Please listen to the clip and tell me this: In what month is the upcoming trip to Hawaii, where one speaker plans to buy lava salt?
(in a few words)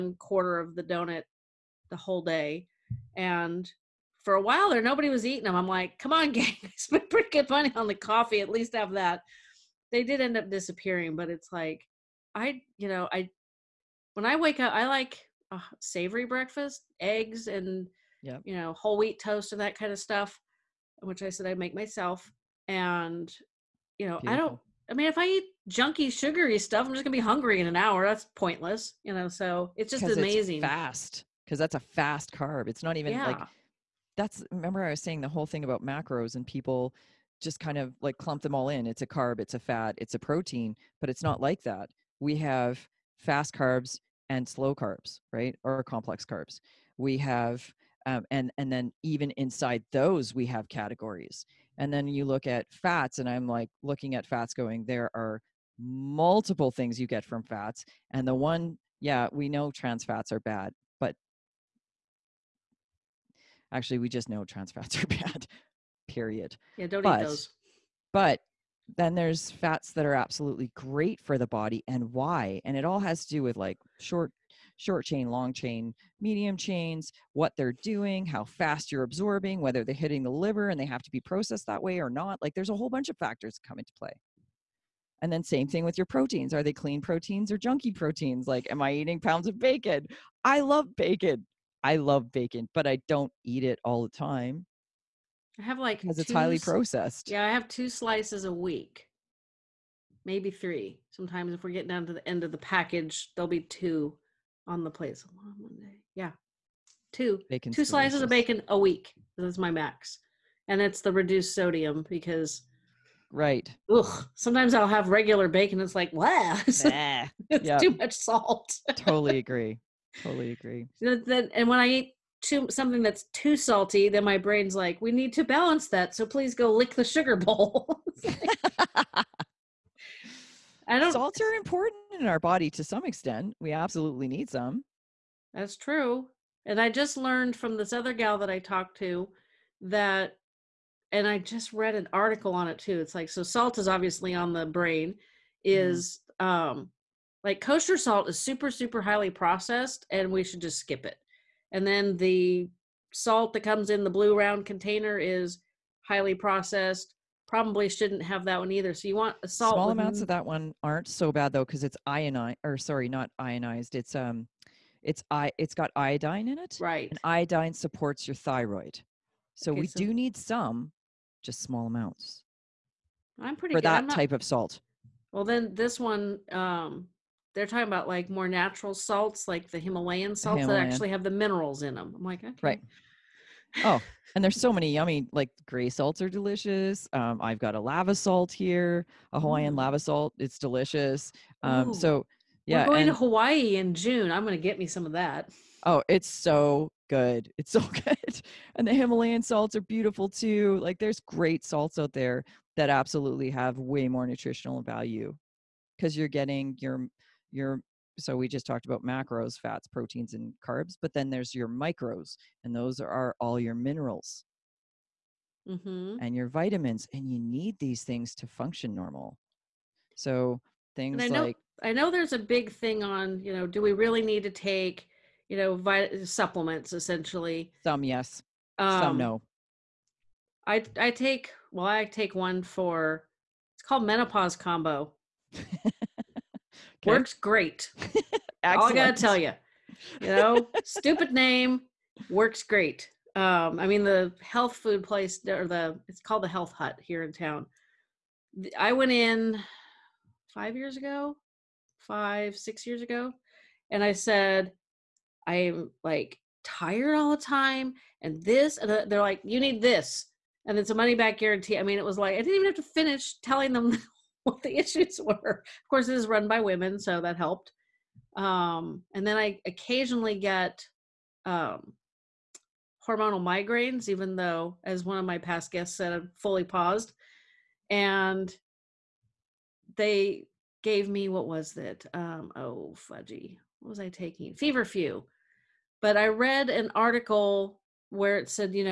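June.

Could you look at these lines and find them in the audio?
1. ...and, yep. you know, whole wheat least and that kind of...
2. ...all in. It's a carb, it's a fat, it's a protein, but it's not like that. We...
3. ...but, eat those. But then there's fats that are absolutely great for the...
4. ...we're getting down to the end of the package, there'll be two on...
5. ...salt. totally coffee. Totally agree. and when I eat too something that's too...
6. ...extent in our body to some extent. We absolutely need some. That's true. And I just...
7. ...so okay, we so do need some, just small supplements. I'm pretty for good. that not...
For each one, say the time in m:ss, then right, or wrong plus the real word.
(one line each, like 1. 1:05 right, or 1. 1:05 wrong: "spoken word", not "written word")
1. 0:17 wrong: "toast", not "least"
2. 0:38 right
3. 1:07 right
4. 1:41 right
5. 1:58 wrong: "agree", not "coffee"
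6. 2:11 wrong: "important", not "extent"
7. 2:49 wrong: "amounts", not "supplements".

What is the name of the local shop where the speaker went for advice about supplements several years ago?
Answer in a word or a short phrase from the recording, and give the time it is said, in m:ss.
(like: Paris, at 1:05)
Health Hut, at 4:06.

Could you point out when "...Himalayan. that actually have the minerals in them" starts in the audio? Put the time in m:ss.
3:00.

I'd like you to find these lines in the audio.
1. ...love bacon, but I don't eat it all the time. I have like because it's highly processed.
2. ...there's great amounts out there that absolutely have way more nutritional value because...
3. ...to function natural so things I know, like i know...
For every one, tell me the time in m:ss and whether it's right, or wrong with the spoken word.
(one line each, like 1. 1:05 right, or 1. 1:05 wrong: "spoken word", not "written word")
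1. 1:31 right
2. 3:20 wrong: "salts", not "amounts"
3. 3:38 wrong: "normal", not "natural".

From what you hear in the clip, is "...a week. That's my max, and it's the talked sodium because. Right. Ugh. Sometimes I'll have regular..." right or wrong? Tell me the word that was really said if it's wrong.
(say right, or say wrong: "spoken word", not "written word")
wrong: "reduced", not "talked".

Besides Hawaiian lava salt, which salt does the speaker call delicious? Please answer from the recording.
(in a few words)
Gray salts.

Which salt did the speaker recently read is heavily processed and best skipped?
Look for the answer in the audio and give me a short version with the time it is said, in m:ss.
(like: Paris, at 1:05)
Kosher salt, at 2:27.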